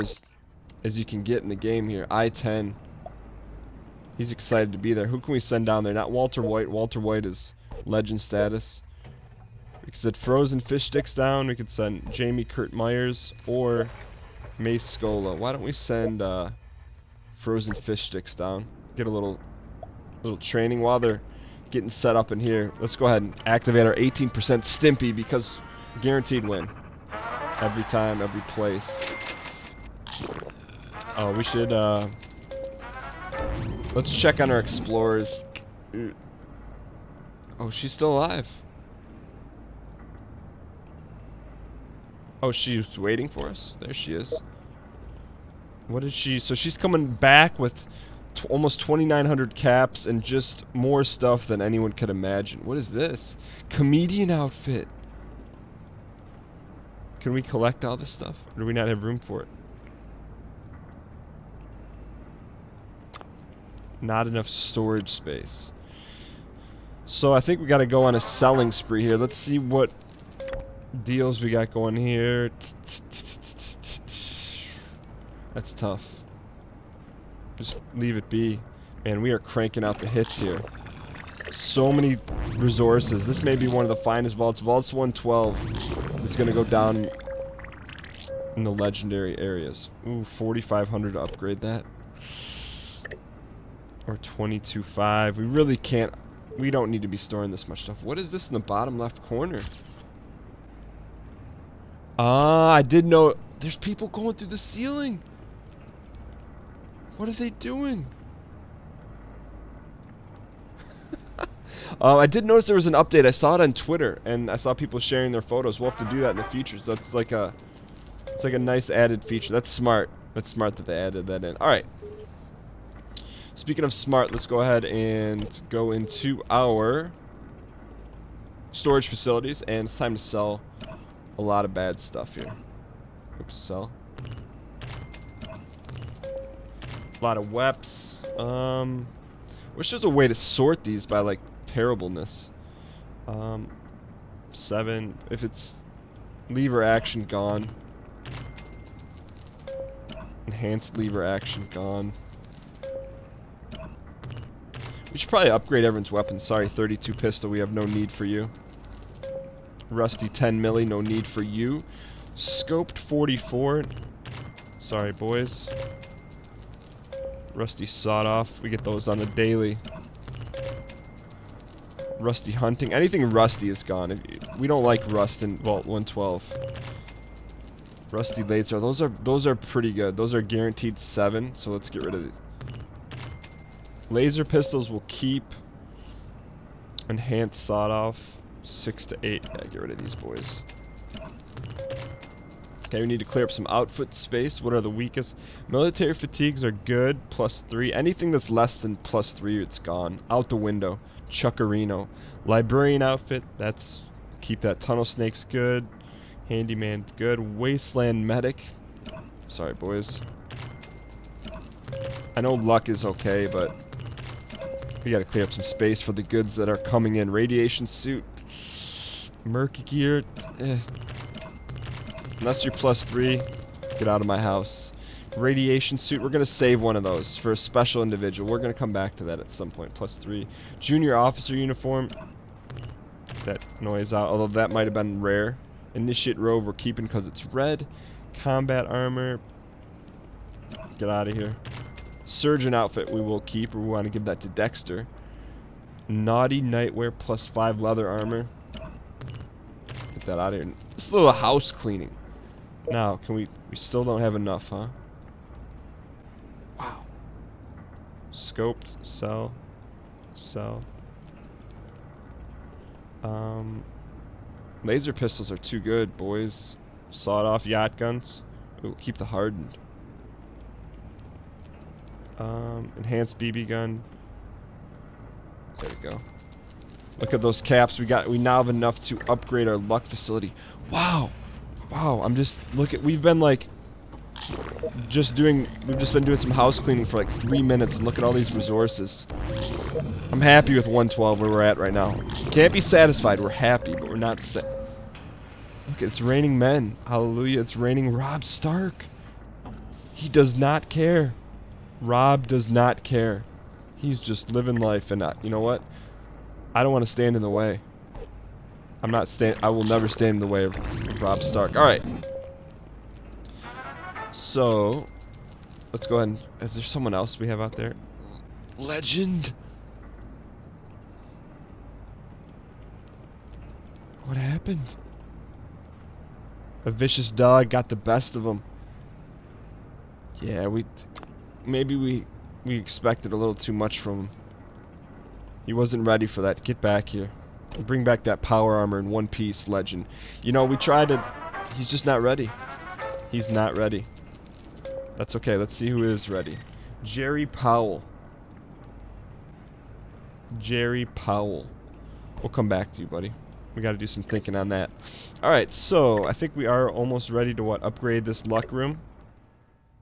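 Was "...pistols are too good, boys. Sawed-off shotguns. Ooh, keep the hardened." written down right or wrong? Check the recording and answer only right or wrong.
right.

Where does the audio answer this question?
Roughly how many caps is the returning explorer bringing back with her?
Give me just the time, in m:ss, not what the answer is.
0:48.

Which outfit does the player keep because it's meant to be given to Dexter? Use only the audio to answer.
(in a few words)
Surgeon outfit.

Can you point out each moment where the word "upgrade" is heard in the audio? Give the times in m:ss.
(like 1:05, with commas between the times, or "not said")
1:31, 2:35, 4:39, 5:57.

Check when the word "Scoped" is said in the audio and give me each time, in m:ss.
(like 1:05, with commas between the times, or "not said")
2:42, 4:18.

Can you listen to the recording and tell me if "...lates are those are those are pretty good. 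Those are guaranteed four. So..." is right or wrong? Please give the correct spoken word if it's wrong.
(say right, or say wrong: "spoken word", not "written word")
wrong: "seven", not "four".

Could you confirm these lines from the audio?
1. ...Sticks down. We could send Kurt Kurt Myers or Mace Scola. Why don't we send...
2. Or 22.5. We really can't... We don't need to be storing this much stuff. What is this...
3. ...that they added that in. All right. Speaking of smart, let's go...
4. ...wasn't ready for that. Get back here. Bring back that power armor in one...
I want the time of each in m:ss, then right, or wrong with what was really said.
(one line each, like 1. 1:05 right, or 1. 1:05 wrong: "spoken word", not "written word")
1. 0:10 wrong: "Jamie", not "Kurt"
2. 1:34 right
3. 2:00 right
4. 5:35 right.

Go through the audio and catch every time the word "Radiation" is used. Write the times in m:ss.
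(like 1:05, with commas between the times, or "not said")
3:37, 3:45.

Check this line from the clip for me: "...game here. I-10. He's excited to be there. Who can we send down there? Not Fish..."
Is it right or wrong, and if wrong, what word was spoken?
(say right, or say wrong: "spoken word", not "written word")
wrong: "Walter", not "Fish".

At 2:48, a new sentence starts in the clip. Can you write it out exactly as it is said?
We get those on the daily.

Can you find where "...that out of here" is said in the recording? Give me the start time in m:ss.
4:10.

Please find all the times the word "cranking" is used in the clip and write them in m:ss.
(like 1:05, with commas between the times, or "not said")
1:19.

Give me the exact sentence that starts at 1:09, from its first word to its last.
Let's see what deals we got going here.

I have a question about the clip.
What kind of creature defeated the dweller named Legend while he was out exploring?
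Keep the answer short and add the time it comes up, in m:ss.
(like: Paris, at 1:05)
A vicious dog, at 5:26.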